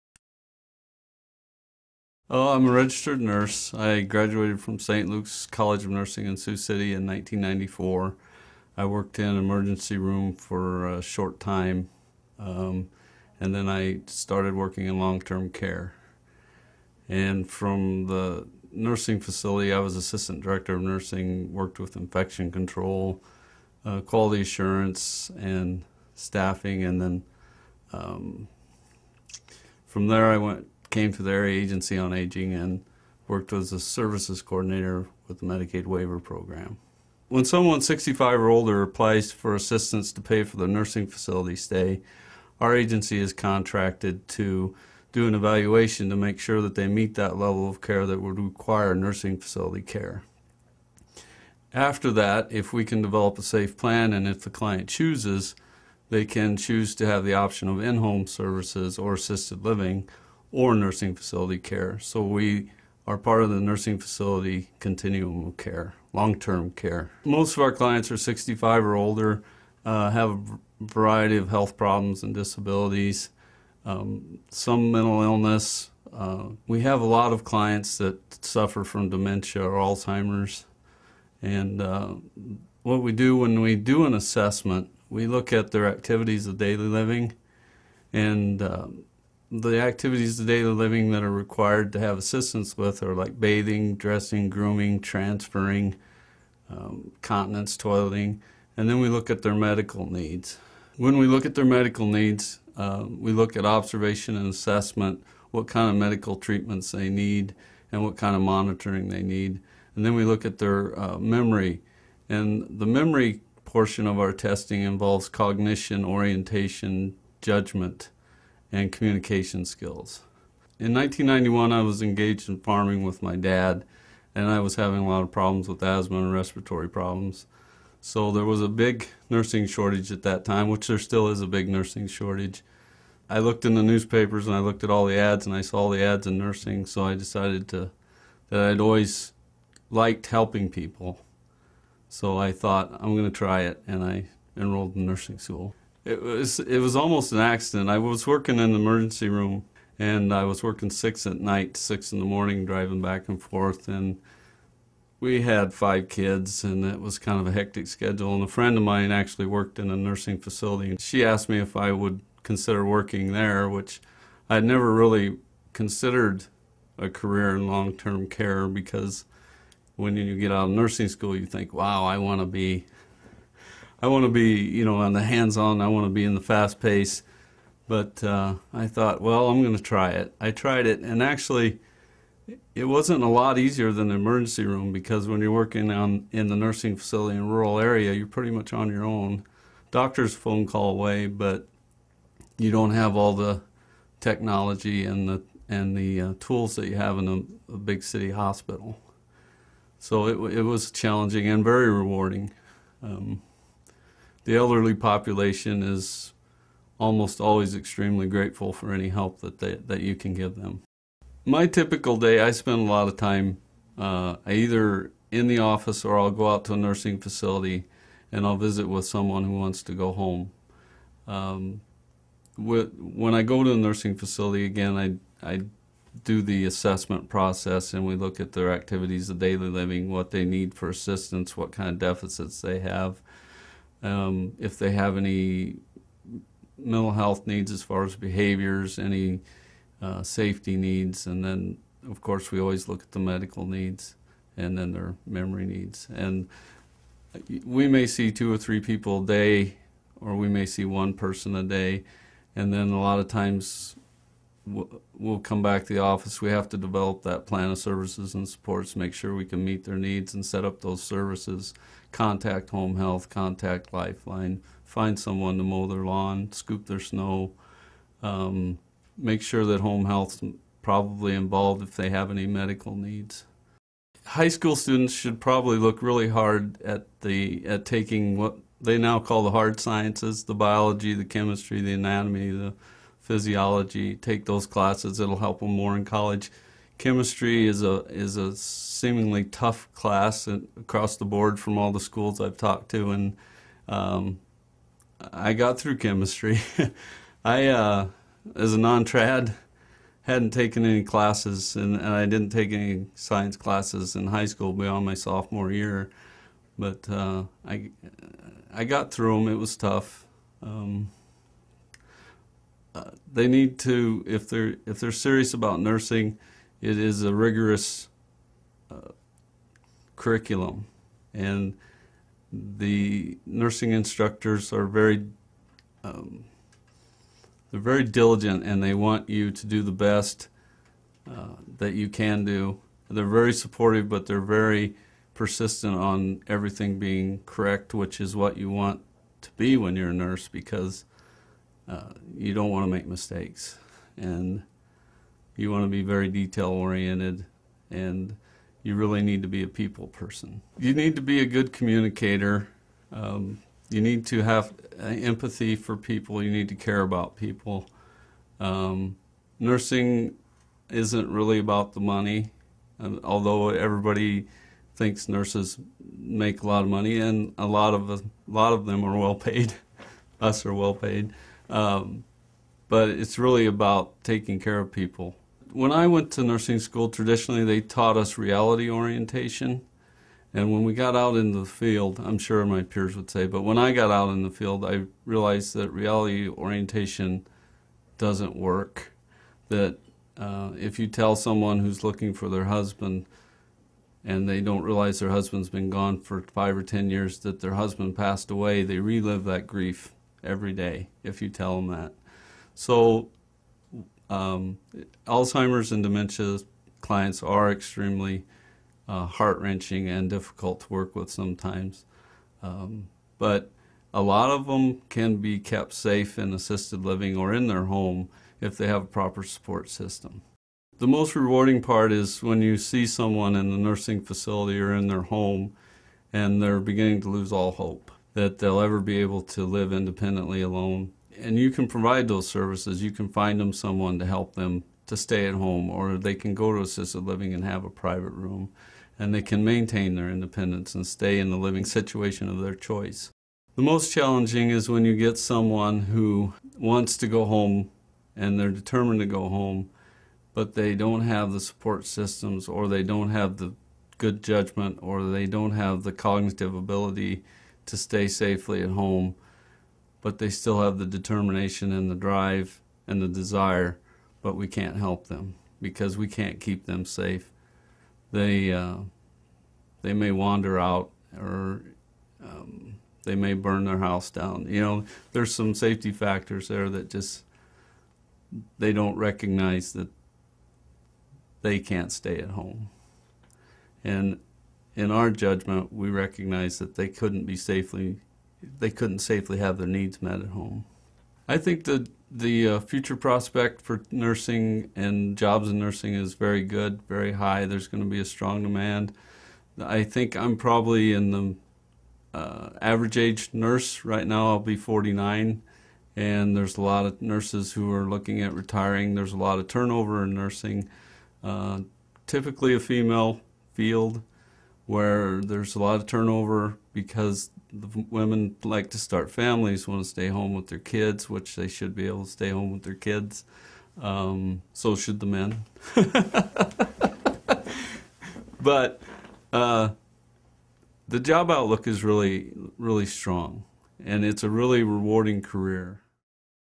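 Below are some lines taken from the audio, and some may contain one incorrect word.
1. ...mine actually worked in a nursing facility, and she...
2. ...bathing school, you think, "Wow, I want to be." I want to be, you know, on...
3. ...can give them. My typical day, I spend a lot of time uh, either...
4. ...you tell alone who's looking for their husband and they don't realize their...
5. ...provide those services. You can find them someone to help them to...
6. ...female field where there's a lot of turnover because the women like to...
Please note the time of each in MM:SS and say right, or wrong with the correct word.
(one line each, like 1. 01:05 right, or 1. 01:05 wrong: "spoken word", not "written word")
1. 02:38 right
2. 02:50 wrong: "nursing", not "bathing"
3. 03:30 right
4. 06:30 wrong: "someone", not "alone"
5. 07:11 right
6. 08:32 right.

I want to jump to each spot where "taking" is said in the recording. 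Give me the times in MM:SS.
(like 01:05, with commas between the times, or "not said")
04:37, 06:14.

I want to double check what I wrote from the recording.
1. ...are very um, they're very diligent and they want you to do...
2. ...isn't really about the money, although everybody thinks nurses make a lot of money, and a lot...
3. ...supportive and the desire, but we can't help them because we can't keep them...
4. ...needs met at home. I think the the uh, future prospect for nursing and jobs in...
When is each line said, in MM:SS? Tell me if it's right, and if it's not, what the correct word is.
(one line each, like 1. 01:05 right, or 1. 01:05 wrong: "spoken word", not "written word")
1. 05:24 right
2. 06:00 right
3. 07:42 wrong: "drive", not "supportive"
4. 08:09 right.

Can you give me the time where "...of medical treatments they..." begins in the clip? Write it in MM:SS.
01:45.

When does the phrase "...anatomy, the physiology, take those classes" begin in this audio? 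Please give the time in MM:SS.
04:41.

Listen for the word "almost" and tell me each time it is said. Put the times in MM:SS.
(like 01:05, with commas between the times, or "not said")
02:26, 03:26.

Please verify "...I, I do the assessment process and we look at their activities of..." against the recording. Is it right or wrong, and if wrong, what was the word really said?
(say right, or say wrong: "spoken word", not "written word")
right.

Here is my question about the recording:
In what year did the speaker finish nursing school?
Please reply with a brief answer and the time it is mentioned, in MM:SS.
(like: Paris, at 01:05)
1994, at 00:07.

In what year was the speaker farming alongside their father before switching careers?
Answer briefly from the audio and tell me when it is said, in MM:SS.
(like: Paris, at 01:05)
1991, at 02:00.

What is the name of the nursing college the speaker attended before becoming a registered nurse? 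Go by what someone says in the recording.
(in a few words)
St. Luke's College of Nursing.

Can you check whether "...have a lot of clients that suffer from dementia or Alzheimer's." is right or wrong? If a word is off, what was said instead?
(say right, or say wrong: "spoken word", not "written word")
right.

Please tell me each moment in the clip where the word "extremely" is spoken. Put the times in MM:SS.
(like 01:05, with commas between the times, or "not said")
03:27, 06:47.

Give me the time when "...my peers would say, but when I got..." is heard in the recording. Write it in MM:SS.
06:22.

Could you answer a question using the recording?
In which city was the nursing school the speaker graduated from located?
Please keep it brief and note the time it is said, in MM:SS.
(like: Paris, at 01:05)
Sioux City, at 00:06.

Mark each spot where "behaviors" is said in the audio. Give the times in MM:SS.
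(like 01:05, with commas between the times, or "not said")
03:58.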